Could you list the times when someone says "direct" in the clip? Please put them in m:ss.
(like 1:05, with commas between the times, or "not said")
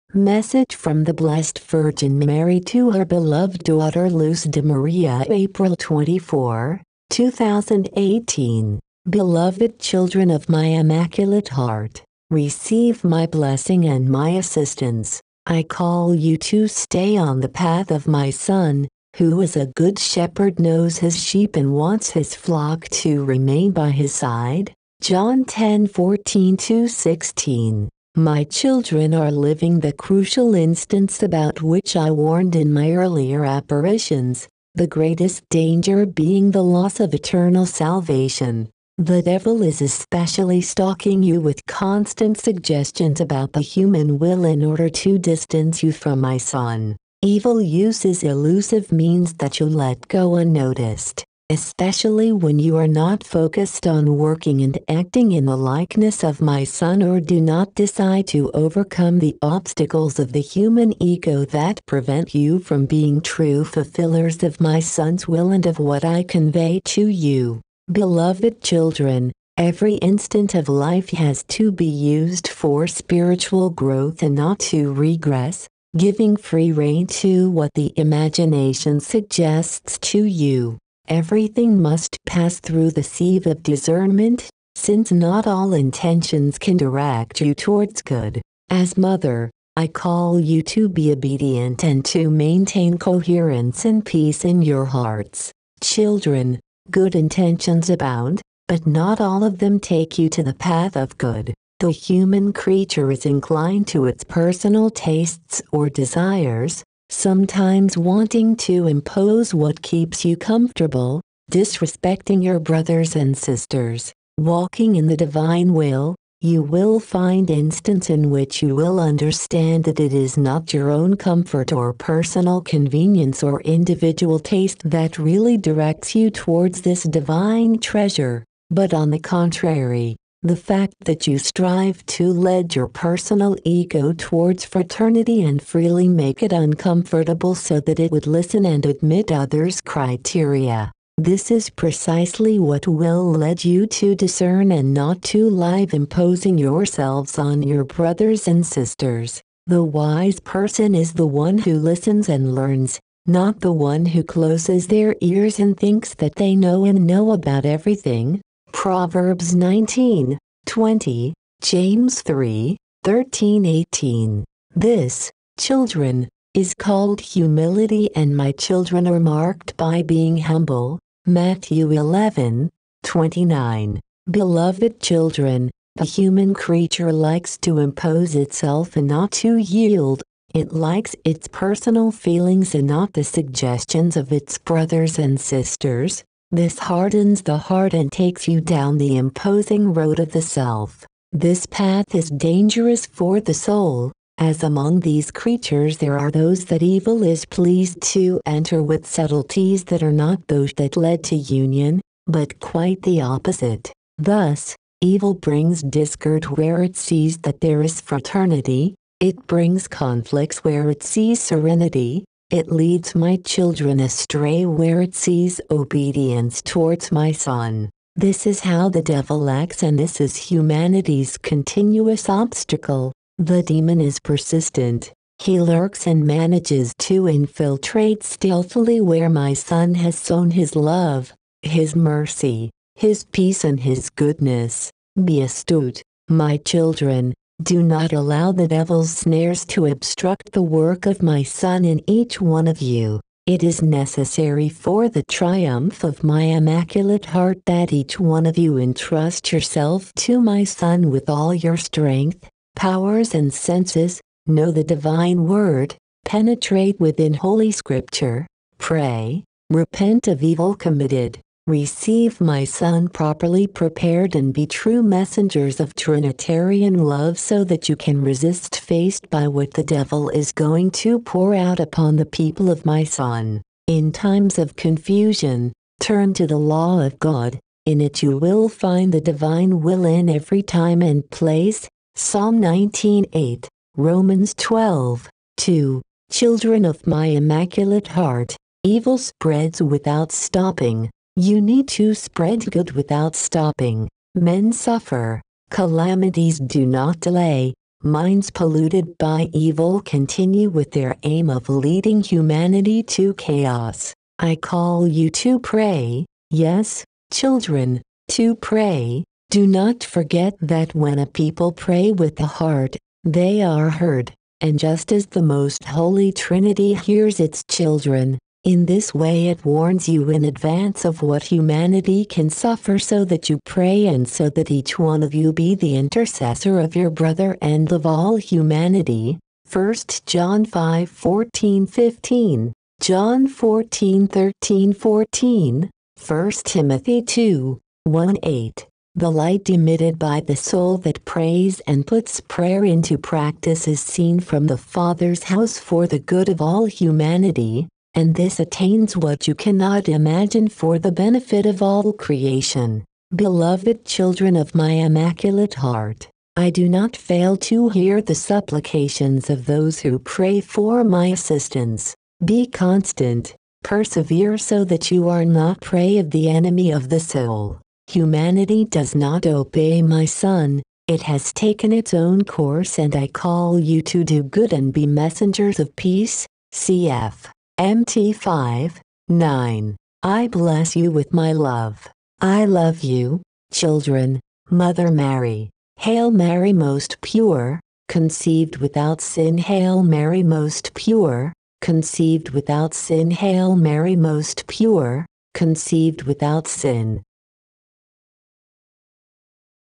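1:26, 2:05.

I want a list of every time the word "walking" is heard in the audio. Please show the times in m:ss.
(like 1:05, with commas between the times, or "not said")
1:54.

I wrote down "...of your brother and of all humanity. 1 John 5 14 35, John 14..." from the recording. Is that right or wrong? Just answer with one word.
wrong.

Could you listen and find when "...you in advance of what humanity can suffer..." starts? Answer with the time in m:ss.
5:20.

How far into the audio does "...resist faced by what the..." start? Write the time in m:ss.
4:28.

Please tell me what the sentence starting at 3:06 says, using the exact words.
This hardens the heart and takes you down the imposing road of the self.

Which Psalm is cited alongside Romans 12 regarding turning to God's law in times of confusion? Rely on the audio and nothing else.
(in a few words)
Psalm 19:8.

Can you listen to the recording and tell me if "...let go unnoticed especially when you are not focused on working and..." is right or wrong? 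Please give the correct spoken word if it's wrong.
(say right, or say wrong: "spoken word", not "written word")
right.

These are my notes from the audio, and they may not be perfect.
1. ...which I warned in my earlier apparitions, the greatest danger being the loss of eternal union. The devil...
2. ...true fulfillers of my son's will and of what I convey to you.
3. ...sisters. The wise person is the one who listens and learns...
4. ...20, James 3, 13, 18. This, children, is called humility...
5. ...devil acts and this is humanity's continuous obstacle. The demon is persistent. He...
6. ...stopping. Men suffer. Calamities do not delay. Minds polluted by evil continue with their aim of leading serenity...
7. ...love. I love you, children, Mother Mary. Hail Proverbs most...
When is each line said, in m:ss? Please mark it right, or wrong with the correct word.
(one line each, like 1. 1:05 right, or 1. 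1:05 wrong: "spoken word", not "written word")
1. 0:31 wrong: "salvation", not "union"
2. 1:03 right
3. 2:28 right
4. 2:40 right
5. 3:39 right
6. 4:53 wrong: "humanity", not "serenity"
7. 6:21 wrong: "Mary", not "Proverbs".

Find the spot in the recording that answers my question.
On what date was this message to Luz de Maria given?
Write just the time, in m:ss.
0:05.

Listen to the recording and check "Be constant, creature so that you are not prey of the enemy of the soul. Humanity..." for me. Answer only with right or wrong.
wrong.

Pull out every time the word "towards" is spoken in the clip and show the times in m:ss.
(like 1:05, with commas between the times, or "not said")
1:27, 2:06, 2:14, 3:36.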